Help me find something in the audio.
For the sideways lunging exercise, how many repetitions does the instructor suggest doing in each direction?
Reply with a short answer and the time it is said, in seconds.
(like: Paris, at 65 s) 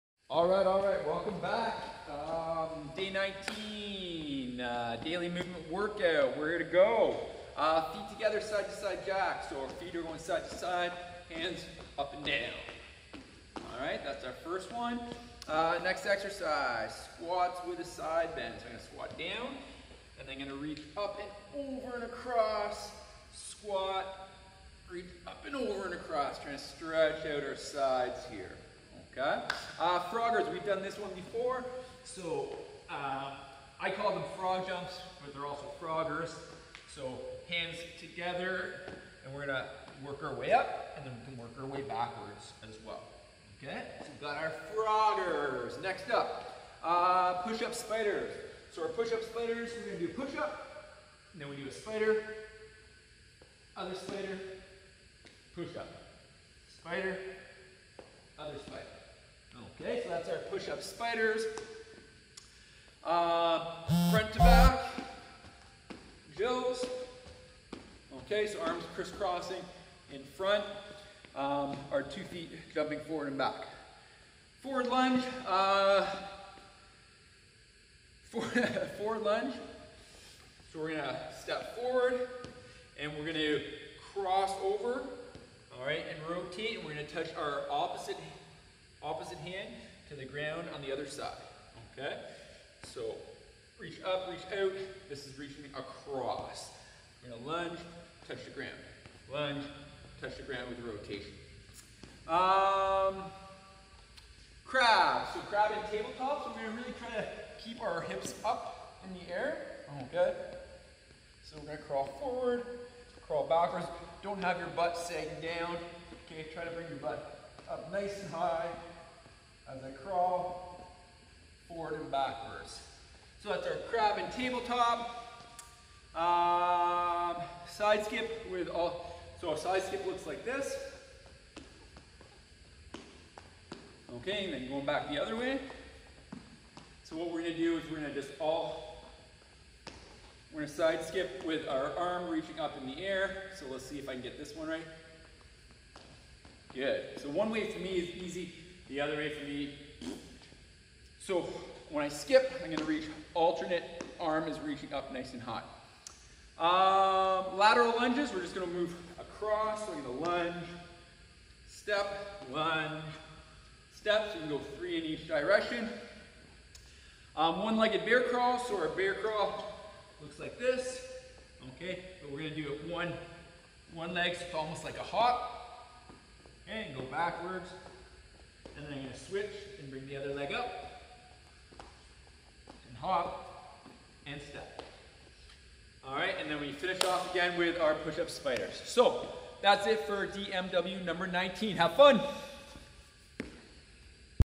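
3, at 164 s.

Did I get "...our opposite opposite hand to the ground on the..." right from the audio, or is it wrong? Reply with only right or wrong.
right.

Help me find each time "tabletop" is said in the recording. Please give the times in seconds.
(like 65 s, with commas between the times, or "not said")
105 s, 124 s.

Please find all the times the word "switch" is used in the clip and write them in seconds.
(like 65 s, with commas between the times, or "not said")
179 s.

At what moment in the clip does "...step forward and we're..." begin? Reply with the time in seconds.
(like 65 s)
81 s.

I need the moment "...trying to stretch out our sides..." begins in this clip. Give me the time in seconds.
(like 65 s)
26 s.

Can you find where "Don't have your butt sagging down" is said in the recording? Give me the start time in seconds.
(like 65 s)
114 s.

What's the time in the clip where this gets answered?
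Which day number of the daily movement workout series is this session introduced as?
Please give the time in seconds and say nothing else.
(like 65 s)
2 s.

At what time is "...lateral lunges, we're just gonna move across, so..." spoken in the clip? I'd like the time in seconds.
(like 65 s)
157 s.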